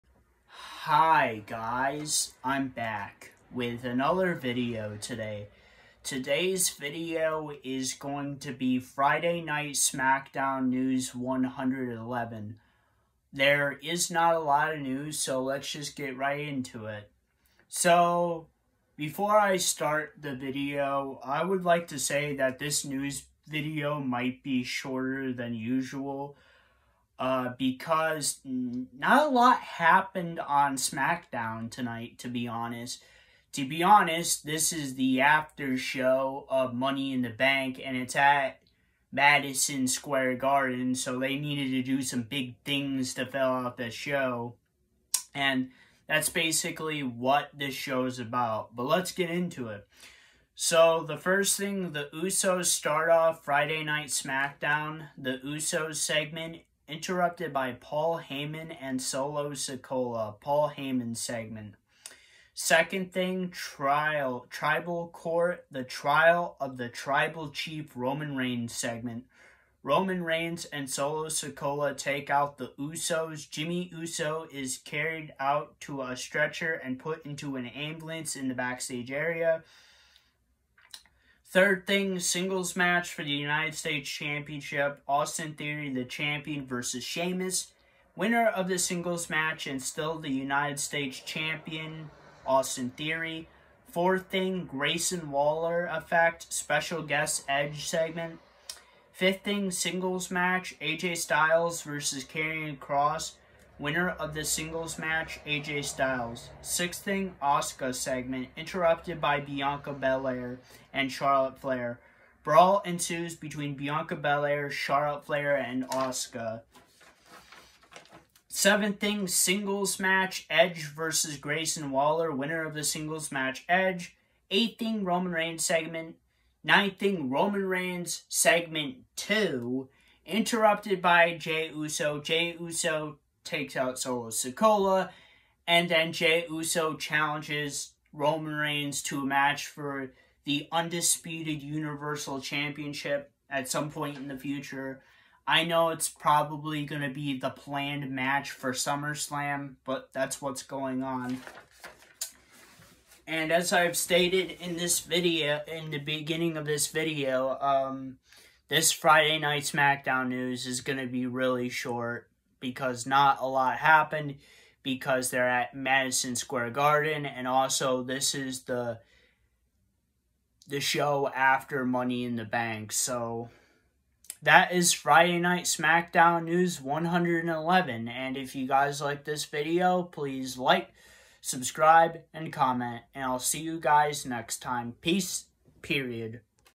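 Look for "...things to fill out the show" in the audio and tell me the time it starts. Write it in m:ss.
0:42.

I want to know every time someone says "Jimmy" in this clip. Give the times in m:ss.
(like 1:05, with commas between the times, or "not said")
1:13.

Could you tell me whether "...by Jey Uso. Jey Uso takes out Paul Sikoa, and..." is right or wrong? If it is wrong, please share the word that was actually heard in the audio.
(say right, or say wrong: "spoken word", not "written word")
wrong: "Solo", not "Paul".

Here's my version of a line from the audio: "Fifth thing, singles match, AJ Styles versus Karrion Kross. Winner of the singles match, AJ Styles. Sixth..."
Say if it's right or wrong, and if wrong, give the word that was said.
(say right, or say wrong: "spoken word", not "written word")
right.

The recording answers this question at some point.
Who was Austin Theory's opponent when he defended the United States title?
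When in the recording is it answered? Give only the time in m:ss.
1:27.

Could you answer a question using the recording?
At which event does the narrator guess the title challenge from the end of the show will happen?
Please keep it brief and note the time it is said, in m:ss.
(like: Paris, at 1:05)
SummerSlam, at 2:28.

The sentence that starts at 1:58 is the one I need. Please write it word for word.
Seventh thing, singles match, Edge versus Grayson Waller.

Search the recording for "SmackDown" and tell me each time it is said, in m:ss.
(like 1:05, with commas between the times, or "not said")
0:09, 0:30, 0:54, 2:39, 2:55.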